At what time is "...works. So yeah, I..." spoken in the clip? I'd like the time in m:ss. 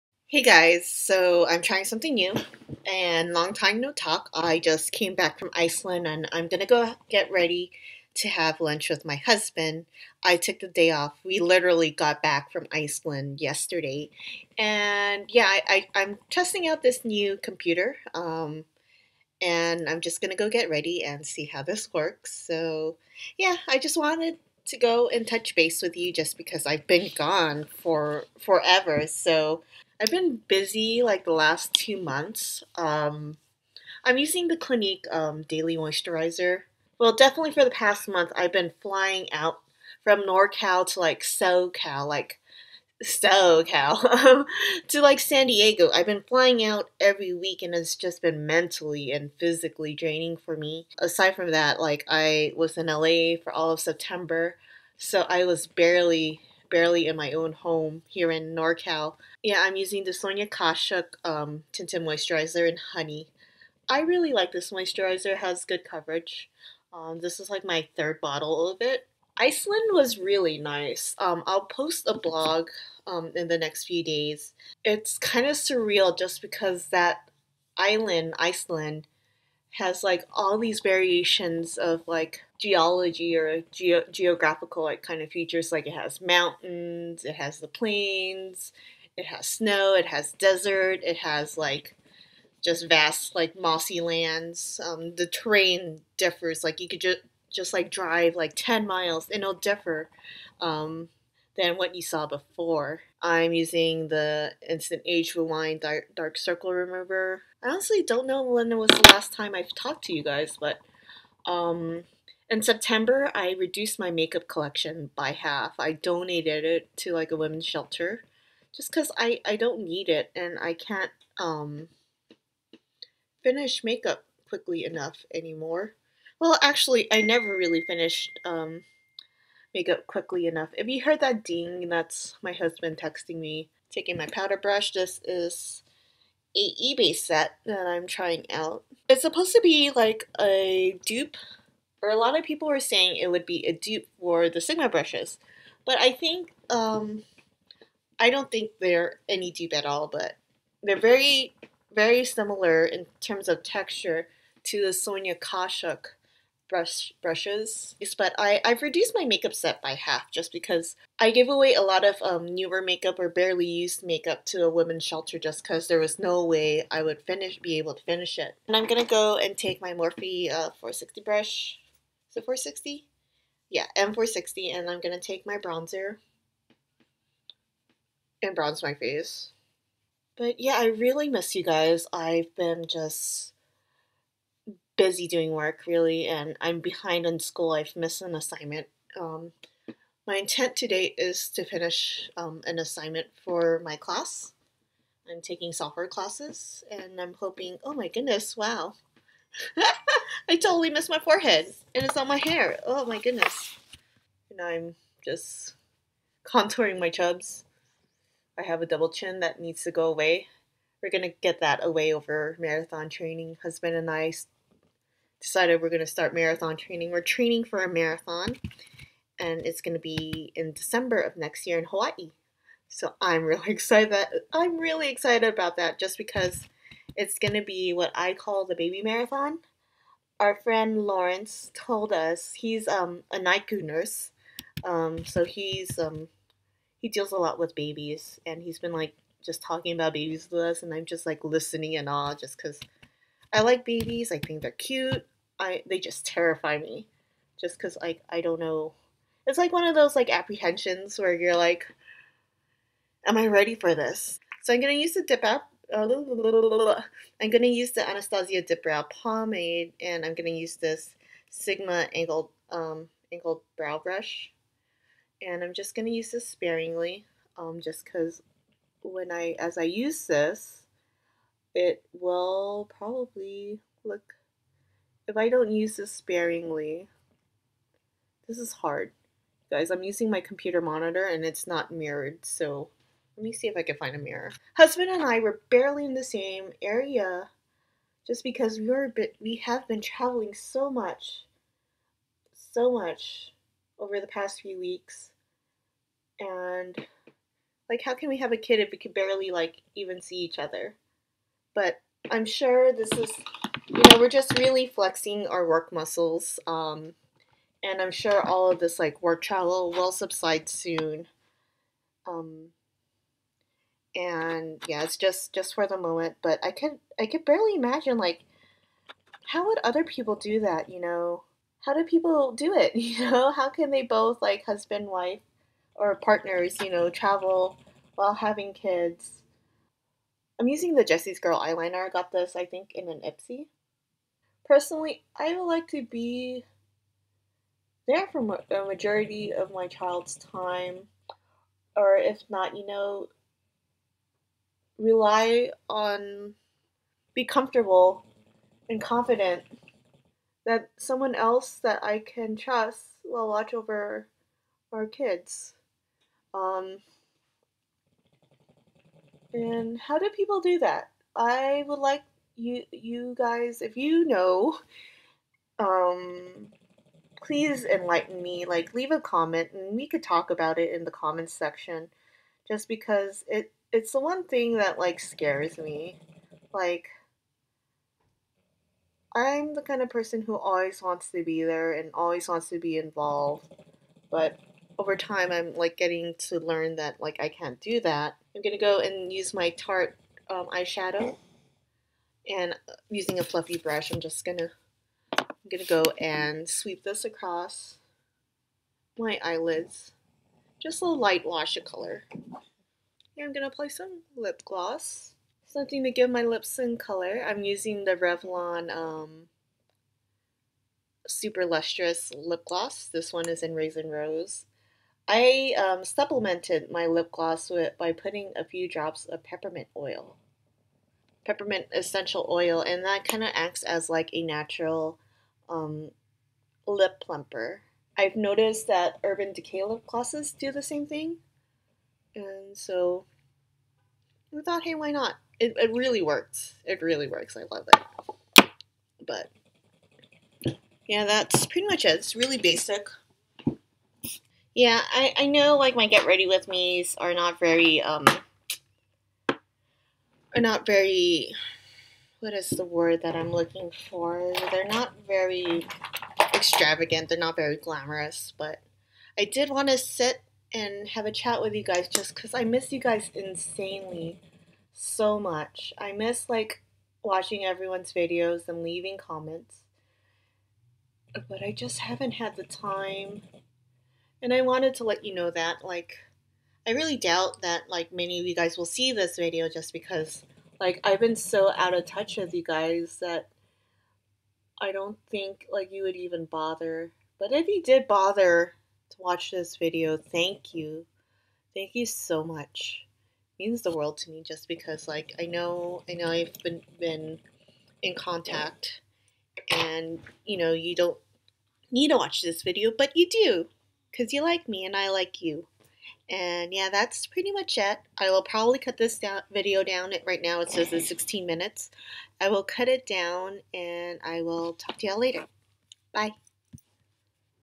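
0:21.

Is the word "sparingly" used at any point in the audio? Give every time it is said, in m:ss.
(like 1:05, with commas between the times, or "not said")
4:26, 4:36.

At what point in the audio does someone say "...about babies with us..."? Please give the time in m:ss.
3:59.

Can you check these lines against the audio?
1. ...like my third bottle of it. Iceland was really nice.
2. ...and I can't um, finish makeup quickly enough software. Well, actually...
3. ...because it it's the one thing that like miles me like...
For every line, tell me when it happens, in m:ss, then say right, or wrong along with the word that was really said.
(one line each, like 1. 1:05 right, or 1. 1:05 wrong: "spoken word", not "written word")
1. 1:07 right
2. 2:00 wrong: "anymore", not "software"
3. 6:12 wrong: "scares", not "miles".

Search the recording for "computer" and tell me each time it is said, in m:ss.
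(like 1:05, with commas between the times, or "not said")
0:17, 4:40.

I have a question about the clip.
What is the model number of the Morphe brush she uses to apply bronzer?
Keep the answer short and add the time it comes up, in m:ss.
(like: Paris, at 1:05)
M460, at 2:53.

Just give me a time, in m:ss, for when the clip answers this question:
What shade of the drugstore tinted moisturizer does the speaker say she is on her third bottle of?
1:02.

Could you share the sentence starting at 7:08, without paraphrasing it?
I've noticed that Urban Decay lip glosses do the same thing, and so I thought, hey, why not?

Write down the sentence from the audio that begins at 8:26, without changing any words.
And yeah, that's pretty much it.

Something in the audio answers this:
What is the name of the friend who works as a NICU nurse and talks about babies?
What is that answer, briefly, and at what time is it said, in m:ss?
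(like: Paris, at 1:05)
Lawrence, at 3:51.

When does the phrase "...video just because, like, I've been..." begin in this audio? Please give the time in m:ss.
7:59.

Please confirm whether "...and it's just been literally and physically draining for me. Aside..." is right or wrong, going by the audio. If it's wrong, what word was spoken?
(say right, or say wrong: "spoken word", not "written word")
wrong: "mentally", not "literally".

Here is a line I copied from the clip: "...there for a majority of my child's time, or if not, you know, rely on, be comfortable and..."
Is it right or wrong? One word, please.
right.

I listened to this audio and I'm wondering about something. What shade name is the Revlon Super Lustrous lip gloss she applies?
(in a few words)
Raisin Rose.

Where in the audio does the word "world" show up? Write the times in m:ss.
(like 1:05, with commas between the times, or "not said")
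8:13.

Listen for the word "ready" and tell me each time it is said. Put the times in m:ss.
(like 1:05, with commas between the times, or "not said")
0:07, 0:20, 4:13, 7:26.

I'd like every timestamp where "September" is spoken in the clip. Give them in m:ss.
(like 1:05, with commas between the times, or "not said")
0:53, 1:52.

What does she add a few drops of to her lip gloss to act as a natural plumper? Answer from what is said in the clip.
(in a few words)
peppermint oil.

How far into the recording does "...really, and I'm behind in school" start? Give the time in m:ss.
3:05.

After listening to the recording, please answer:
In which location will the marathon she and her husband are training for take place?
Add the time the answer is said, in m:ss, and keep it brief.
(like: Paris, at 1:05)
Hawaii, at 3:41.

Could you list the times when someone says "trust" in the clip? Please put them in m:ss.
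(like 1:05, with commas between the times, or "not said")
5:52.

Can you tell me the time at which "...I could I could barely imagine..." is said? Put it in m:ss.
5:16.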